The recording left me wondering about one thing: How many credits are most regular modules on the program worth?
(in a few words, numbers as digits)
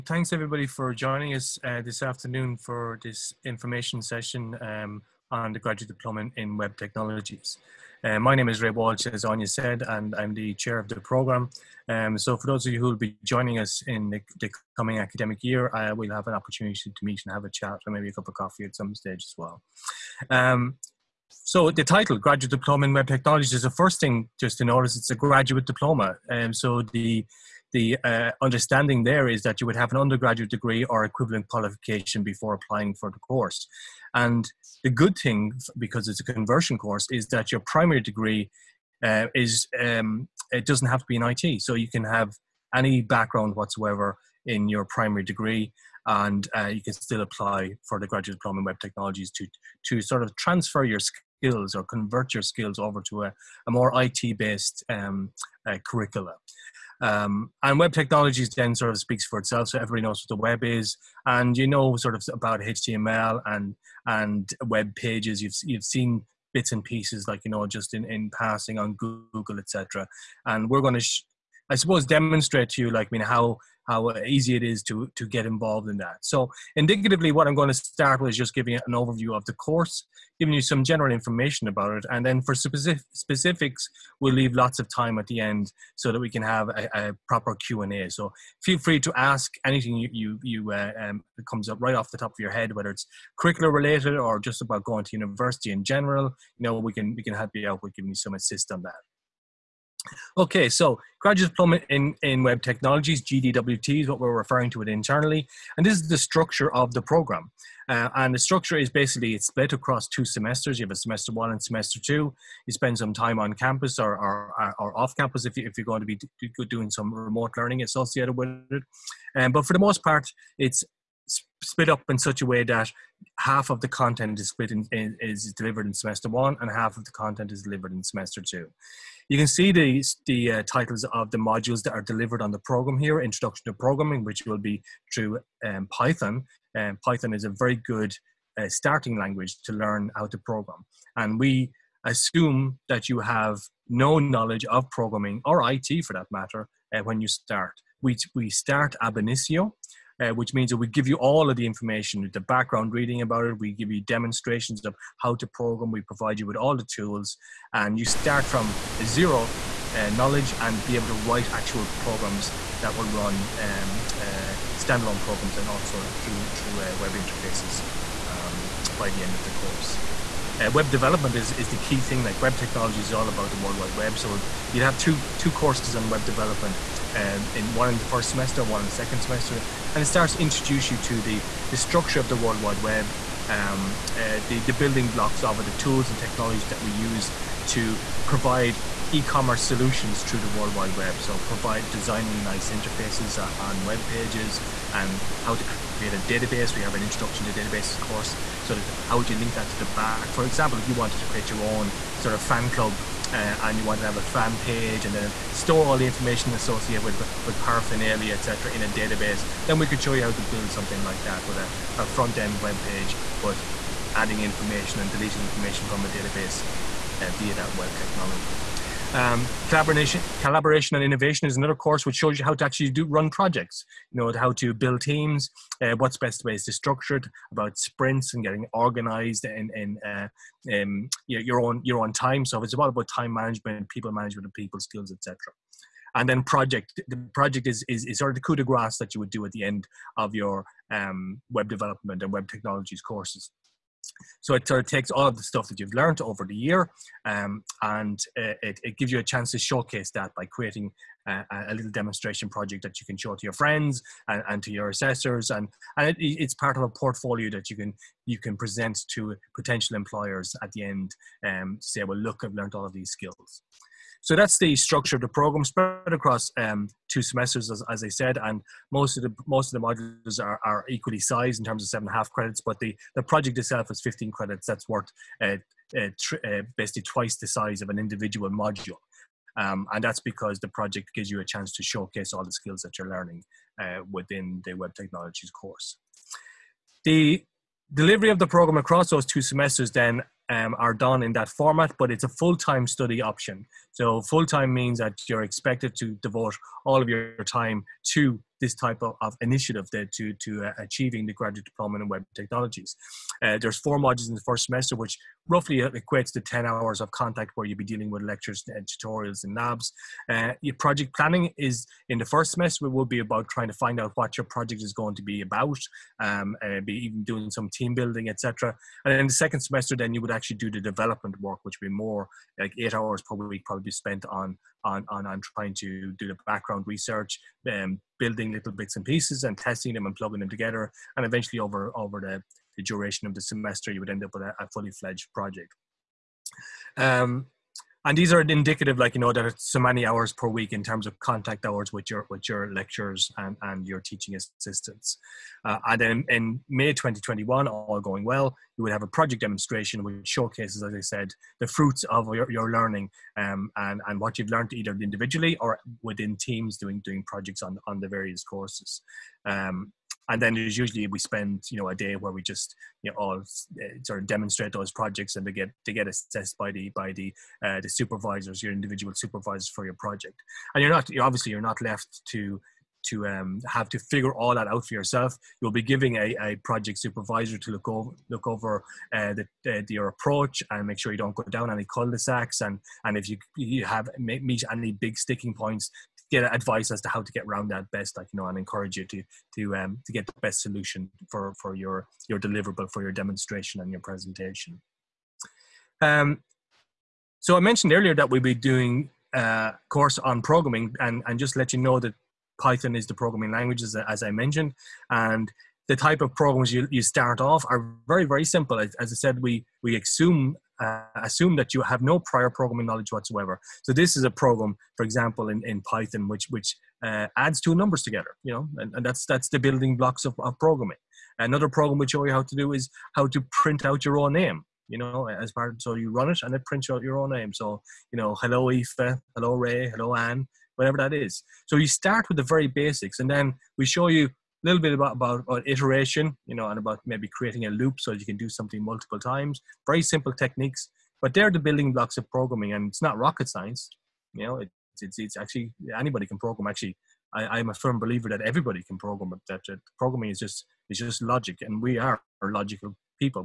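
7.5.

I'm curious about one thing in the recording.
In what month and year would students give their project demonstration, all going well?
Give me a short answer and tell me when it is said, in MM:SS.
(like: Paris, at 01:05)
May 2021, at 05:46.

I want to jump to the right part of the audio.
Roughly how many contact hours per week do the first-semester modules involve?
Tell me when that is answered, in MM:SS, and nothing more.
05:06.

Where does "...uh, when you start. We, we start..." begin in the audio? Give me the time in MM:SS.
02:26.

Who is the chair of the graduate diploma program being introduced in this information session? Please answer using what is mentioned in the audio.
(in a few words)
Ray Walsh.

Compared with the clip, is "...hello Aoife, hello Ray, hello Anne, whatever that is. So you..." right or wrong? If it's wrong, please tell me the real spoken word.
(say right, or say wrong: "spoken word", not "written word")
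right.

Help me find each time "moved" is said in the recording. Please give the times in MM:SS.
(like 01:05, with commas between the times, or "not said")
not said.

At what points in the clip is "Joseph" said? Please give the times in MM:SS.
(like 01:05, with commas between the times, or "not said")
not said.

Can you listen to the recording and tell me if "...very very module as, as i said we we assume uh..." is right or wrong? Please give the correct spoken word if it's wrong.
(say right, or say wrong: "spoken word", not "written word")
wrong: "simple", not "module".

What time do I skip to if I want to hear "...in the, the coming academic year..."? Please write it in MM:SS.
00:13.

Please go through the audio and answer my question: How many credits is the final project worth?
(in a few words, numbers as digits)
15.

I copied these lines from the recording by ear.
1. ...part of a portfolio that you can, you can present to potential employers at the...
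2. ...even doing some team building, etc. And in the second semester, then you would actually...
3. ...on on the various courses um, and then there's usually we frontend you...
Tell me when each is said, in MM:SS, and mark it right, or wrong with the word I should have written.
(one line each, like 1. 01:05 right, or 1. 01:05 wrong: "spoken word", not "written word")
1. 04:16 right
2. 05:16 right
3. 05:57 wrong: "spend", not "frontend".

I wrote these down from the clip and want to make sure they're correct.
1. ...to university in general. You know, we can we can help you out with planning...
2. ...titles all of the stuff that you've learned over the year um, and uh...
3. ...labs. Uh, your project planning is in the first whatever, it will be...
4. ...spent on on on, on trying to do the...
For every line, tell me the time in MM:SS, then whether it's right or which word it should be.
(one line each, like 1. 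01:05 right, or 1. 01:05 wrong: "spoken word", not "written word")
1. 01:35 wrong: "giving", not "planning"
2. 04:04 wrong: "takes", not "titles"
3. 05:09 wrong: "semester", not "whatever"
4. 05:23 right.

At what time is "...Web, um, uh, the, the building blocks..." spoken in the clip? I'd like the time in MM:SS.
03:02.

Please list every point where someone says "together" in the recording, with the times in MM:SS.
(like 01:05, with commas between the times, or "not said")
05:30, 06:58.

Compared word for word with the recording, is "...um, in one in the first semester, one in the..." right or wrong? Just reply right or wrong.
right.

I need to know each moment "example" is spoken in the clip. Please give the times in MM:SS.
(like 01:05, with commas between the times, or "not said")
03:20, 06:55.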